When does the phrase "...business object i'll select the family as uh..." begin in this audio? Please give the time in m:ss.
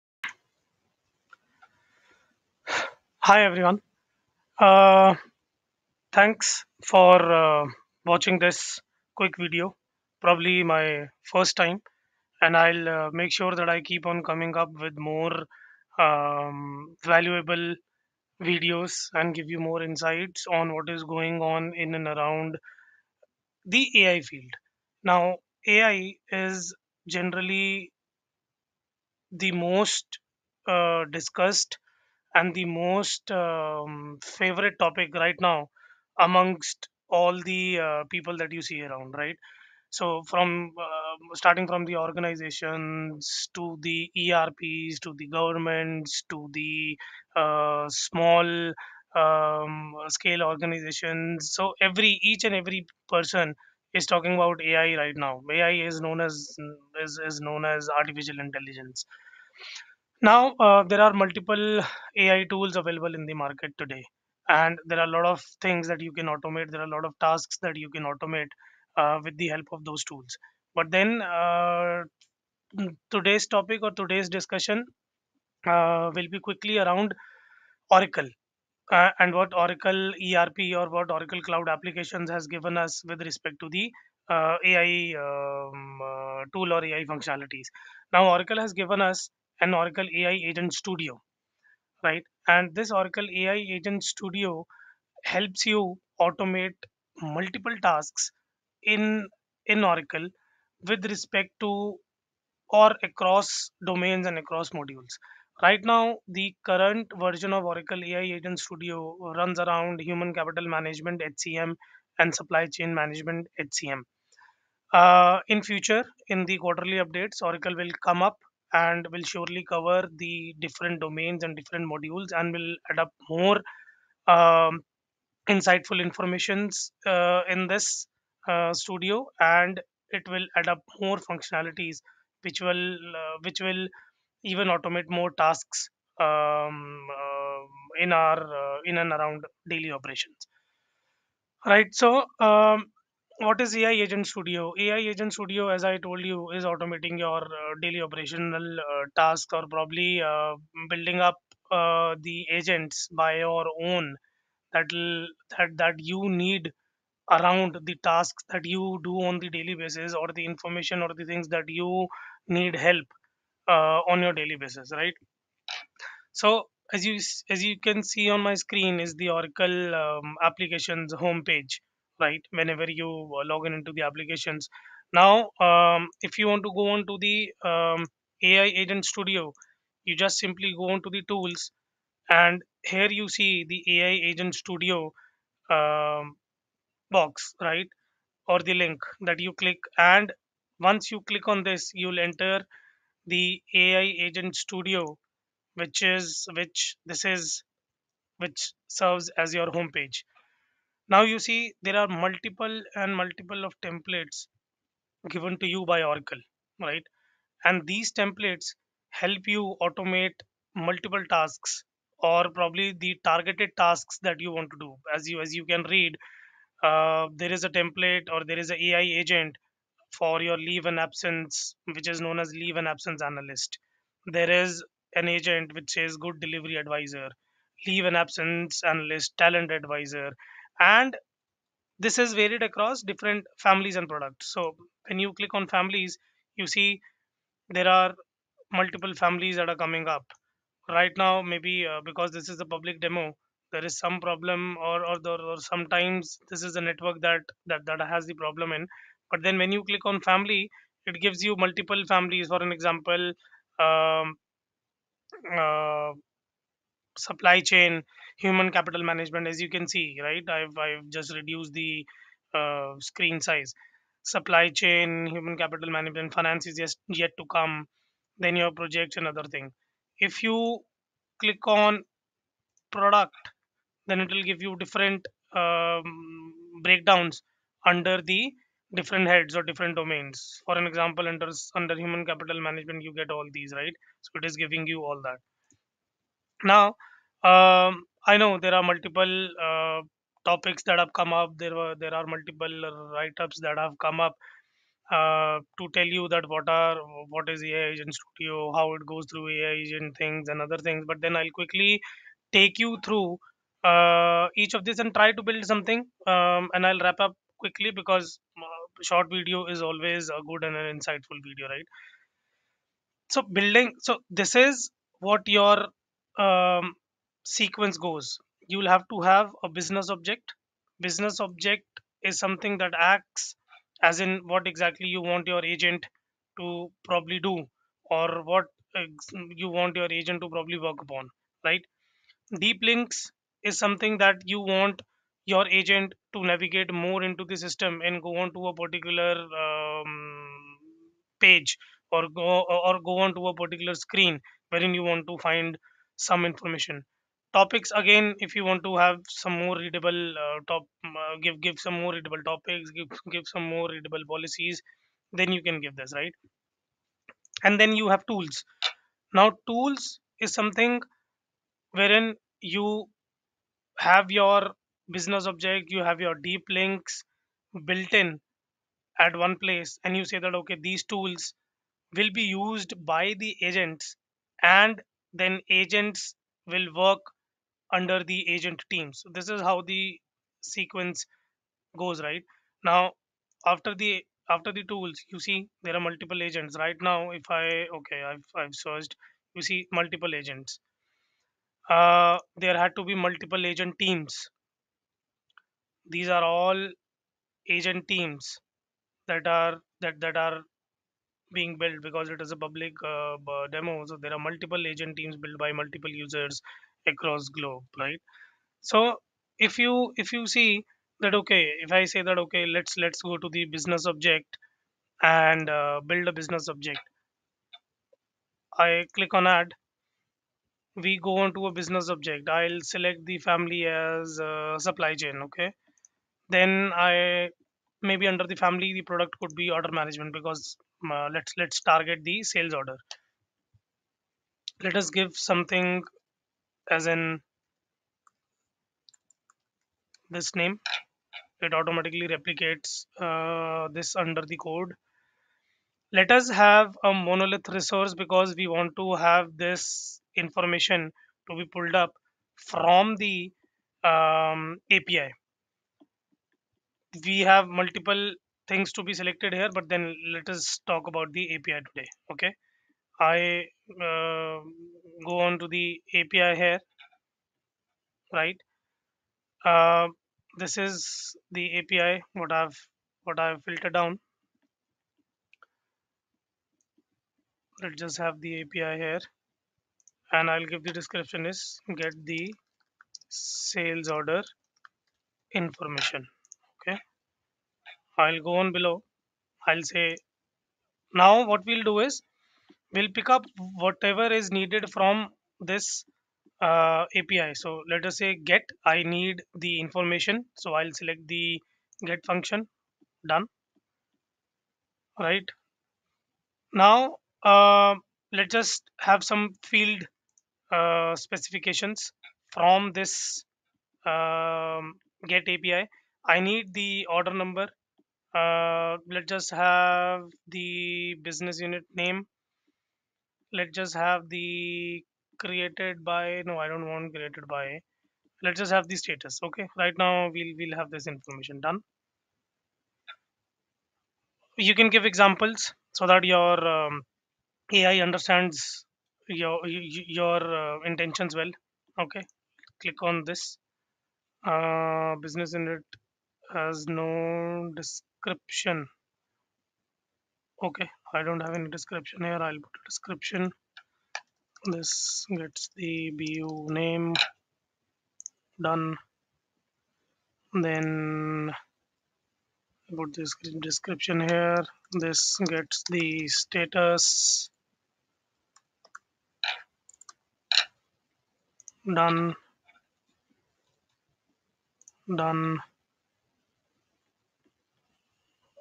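7:01.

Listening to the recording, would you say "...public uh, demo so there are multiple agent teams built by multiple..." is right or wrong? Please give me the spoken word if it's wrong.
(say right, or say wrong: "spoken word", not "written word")
right.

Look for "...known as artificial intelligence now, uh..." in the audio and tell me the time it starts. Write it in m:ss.
0:57.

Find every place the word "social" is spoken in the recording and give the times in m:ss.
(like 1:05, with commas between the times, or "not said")
not said.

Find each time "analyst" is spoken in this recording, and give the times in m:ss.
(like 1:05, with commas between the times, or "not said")
3:43, 3:48.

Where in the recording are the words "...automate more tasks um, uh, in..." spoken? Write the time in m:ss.
2:14.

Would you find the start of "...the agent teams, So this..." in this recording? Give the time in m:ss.
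6:18.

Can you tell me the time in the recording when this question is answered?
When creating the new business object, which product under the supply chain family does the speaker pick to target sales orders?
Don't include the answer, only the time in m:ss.
7:09.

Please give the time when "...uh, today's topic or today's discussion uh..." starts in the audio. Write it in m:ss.
1:11.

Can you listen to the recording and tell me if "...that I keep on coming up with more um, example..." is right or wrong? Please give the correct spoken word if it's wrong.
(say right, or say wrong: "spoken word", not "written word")
wrong: "valuable", not "example".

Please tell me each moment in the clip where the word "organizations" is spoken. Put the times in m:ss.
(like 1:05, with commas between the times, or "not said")
0:41, 0:50.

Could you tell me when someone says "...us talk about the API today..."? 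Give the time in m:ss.
7:40.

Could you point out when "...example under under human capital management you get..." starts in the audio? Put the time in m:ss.
4:40.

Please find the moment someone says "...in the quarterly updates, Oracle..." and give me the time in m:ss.
1:56.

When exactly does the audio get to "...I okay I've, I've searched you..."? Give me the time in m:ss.
6:27.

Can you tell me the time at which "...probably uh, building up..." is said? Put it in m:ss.
2:29.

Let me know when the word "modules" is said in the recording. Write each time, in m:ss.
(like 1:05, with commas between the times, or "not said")
1:44, 2:01.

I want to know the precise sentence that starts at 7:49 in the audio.
Uh, this is the API what I've what I've filtered down.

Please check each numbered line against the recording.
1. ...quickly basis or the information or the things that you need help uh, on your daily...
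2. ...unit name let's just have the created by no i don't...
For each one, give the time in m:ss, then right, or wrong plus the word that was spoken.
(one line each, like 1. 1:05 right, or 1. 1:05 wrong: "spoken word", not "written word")
1. 2:39 wrong: "daily", not "quickly"
2. 8:41 right.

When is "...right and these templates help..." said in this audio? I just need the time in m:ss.
3:26.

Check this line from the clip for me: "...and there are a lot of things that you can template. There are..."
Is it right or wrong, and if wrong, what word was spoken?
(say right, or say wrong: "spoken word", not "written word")
wrong: "automate", not "template".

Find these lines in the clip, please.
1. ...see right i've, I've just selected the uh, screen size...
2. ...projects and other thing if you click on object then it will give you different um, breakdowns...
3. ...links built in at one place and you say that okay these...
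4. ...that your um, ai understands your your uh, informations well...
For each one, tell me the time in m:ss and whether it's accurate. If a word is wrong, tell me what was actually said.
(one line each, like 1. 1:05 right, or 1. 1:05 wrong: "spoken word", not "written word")
1. 4:19 wrong: "reduced", not "selected"
2. 4:28 wrong: "product", not "object"
3. 6:06 right
4. 8:56 wrong: "intentions", not "informations".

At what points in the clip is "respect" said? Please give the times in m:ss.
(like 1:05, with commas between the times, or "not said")
1:23, 1:41.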